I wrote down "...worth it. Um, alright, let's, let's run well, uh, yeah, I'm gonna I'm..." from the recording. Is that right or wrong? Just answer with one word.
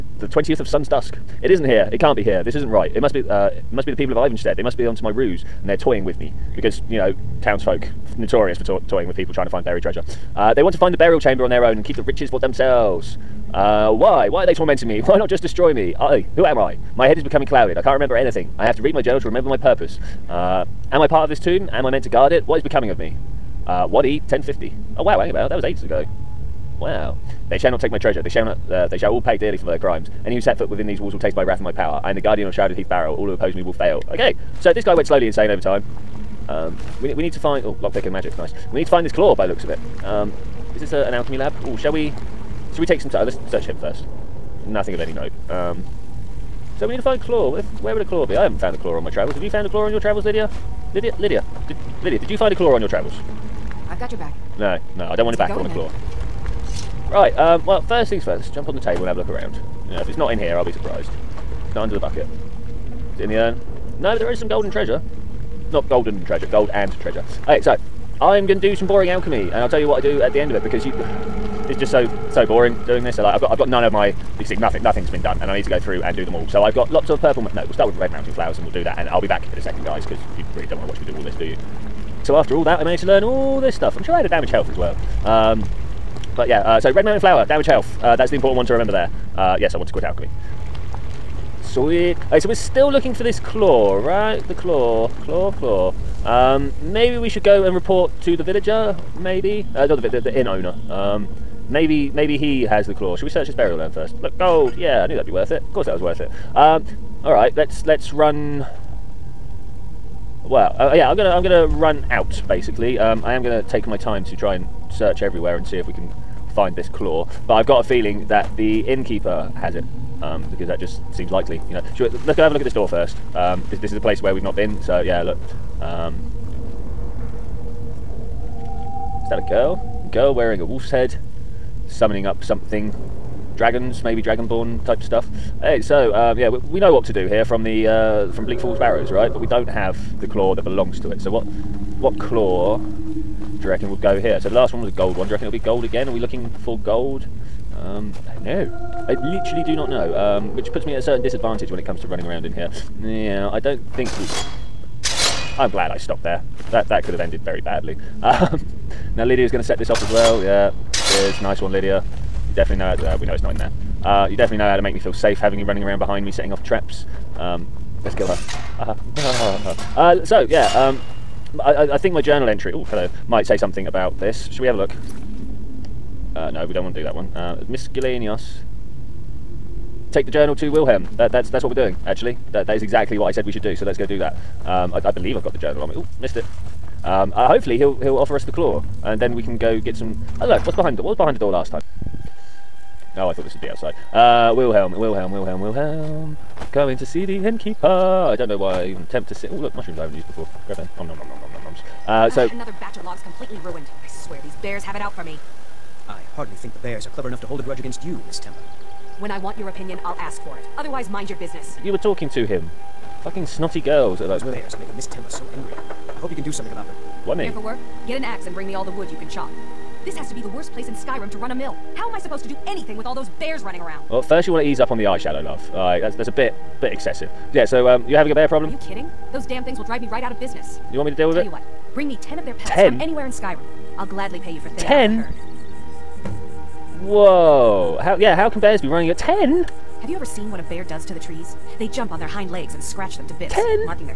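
right.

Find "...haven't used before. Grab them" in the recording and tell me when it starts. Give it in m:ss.
3:20.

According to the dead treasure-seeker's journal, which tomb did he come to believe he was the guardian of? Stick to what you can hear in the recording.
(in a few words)
Shrouded Heath Barrow.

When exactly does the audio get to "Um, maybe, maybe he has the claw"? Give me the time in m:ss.
1:40.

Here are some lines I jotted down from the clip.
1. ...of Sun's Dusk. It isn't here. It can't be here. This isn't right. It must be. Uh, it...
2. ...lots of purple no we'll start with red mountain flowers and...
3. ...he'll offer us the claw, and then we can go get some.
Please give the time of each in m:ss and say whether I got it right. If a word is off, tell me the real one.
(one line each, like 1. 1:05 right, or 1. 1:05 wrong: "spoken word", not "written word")
1. 0:00 right
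2. 1:16 right
3. 3:08 right.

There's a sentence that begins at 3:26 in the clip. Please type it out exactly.
I hardly think the bears are clever enough to hold a grudge against you, Miss Temba.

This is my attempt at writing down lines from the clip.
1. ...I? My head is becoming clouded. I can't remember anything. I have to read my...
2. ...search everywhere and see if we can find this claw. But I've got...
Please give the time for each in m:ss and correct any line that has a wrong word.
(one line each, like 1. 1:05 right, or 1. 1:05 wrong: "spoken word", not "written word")
1. 0:16 right
2. 1:54 right.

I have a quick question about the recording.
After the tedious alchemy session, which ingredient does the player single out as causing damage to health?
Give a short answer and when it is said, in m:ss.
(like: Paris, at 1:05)
Red mountain flower, at 1:26.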